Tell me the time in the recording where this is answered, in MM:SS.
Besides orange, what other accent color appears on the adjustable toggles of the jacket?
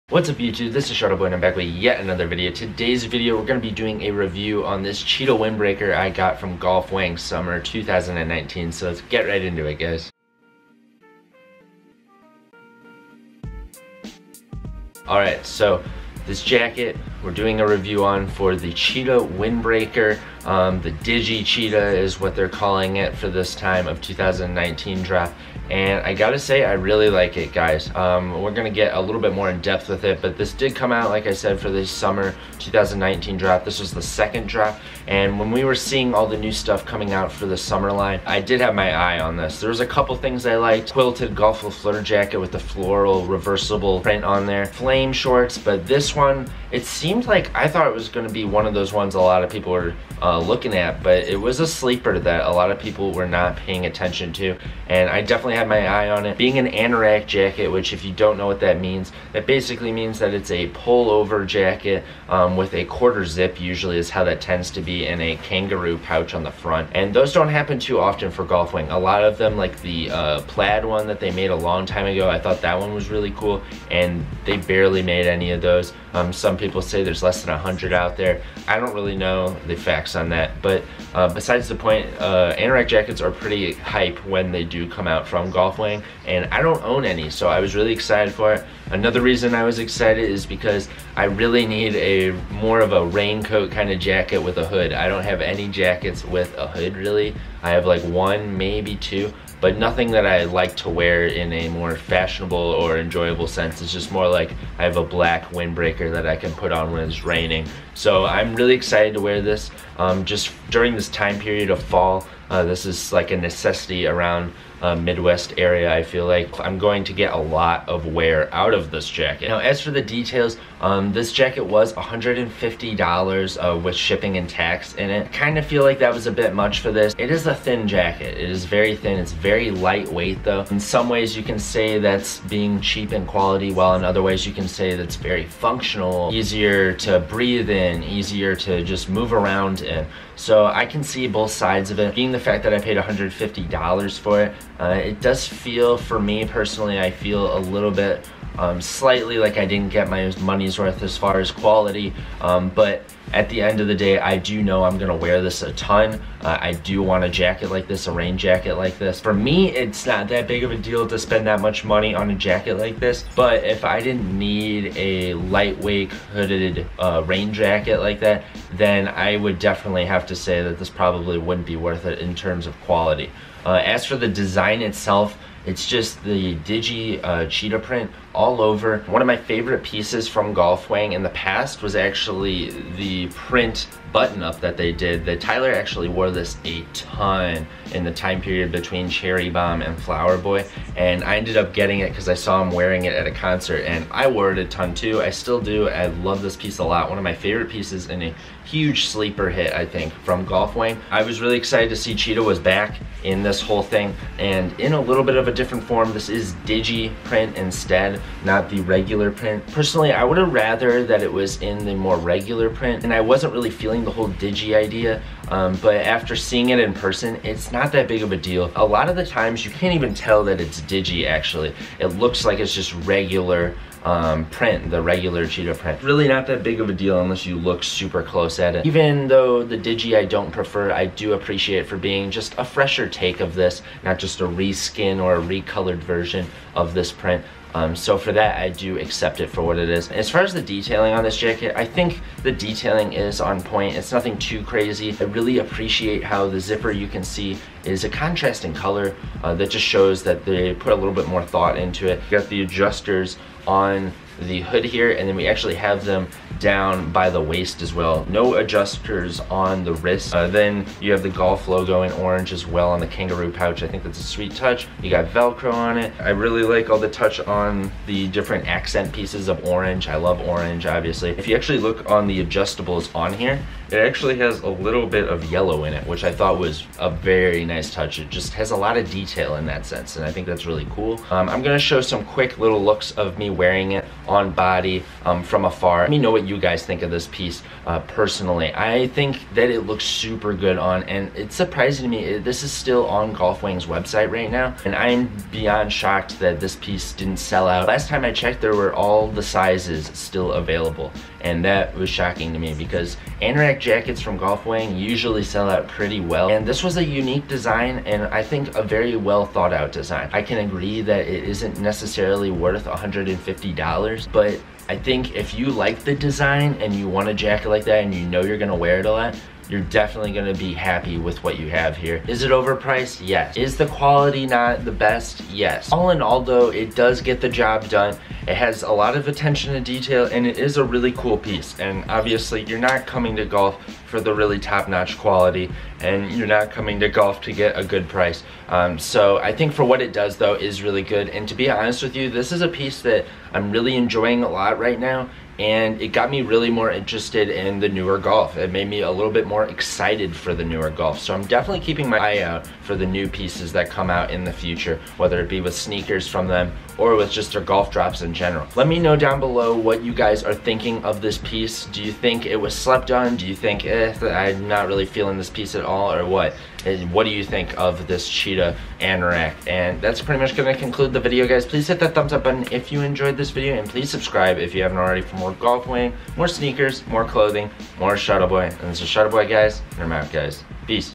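04:35.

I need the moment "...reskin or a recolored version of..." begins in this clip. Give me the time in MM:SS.
03:54.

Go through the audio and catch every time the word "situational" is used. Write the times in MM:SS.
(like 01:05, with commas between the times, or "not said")
not said.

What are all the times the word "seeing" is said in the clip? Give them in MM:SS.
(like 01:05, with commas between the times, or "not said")
00:35, 03:36.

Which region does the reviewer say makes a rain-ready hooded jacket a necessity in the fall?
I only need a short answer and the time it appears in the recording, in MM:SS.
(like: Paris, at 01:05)
Midwest, at 01:54.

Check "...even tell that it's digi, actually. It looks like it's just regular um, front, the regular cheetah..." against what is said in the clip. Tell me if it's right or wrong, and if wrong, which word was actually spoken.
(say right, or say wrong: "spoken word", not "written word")
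wrong: "print", not "front".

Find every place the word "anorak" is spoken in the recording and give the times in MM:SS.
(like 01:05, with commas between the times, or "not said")
00:56, 01:22, 05:03, 06:08.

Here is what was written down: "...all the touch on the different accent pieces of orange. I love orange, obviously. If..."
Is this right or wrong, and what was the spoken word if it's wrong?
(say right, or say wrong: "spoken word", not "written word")
right.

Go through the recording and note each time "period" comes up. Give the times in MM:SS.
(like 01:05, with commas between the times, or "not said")
01:51, 03:08.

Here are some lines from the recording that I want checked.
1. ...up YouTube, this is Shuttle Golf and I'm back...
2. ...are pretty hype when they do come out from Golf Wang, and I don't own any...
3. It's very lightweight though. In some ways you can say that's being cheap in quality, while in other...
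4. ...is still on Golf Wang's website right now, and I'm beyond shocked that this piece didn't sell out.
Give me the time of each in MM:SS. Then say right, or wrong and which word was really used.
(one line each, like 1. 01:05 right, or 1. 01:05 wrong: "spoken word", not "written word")
1. 00:00 wrong: "Boy", not "Golf"
2. 01:23 right
3. 02:09 right
4. 04:52 right.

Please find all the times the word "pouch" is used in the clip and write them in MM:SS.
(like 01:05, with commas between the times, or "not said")
01:05, 04:23.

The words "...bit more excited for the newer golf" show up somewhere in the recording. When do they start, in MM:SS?
05:49.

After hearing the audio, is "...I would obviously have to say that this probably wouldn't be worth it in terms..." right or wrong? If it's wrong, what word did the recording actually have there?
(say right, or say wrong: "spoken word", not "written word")
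wrong: "definitely", not "obviously".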